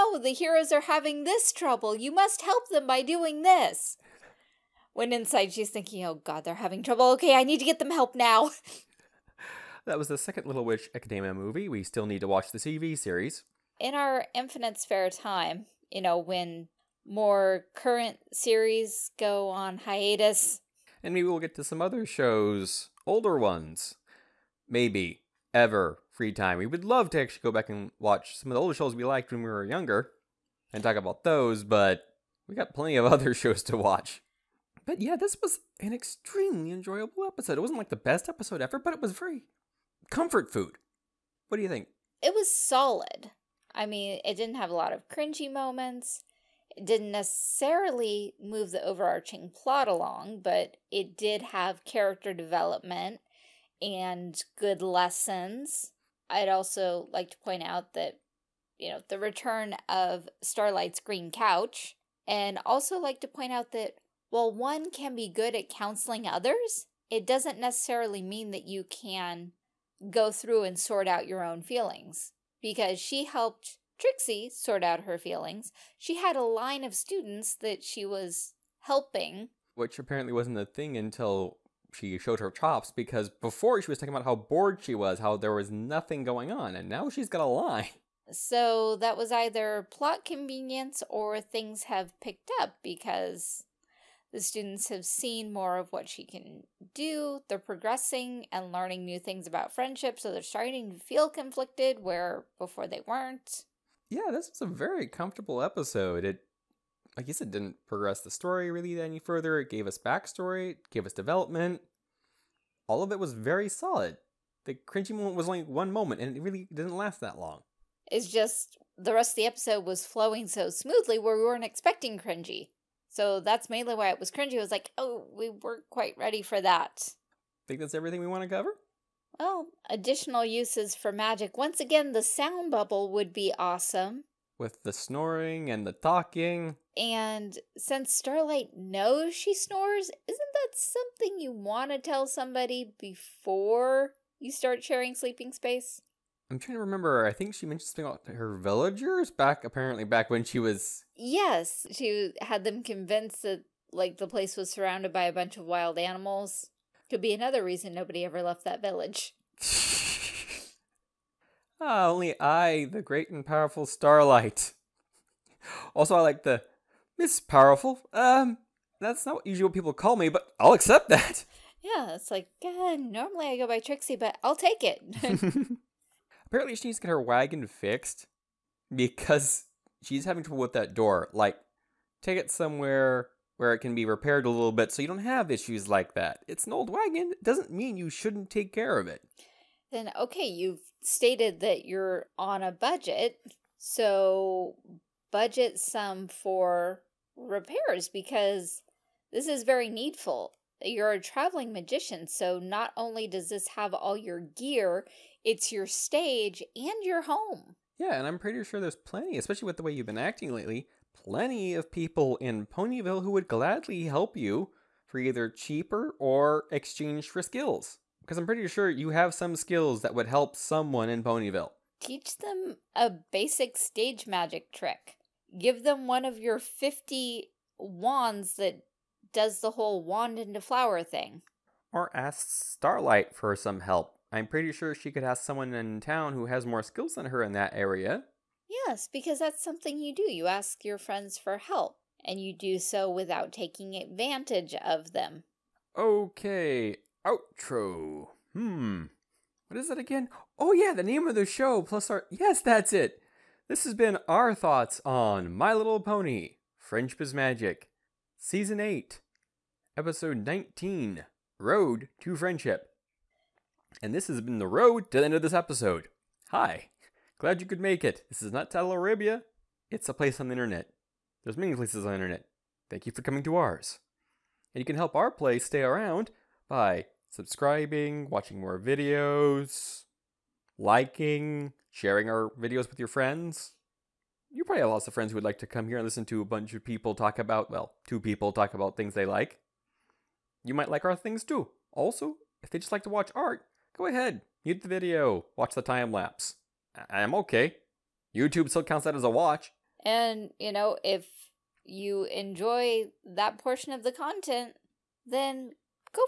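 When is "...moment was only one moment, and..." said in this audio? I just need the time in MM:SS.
01:55.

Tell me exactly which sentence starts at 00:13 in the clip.
In our Infinite Spare Time, you know, when more current series go on hiatus.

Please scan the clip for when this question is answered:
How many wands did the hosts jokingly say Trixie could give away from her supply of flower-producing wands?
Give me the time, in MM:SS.
03:46.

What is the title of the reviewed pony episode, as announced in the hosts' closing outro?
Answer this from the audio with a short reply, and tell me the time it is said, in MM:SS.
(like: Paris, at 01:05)
Road to Friendship, at 04:21.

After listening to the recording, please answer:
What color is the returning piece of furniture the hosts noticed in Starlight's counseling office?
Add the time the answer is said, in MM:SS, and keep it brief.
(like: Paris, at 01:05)
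Green, at 01:01.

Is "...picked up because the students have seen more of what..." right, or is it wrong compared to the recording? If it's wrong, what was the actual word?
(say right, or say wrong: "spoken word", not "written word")
right.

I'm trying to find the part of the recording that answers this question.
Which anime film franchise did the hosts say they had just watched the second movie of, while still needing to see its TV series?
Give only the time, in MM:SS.
00:10.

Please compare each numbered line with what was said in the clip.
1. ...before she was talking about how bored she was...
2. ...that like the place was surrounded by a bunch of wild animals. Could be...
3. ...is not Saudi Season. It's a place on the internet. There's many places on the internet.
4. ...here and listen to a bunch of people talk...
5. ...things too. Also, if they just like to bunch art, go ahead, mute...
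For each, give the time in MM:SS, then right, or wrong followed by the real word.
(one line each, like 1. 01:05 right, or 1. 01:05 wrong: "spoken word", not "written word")
1. 01:23 right
2. 02:33 right
3. 04:28 wrong: "Arabia", not "Season"
4. 04:45 right
5. 04:51 wrong: "watch", not "bunch".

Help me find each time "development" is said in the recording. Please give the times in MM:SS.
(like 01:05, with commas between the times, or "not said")
00:52, 01:51.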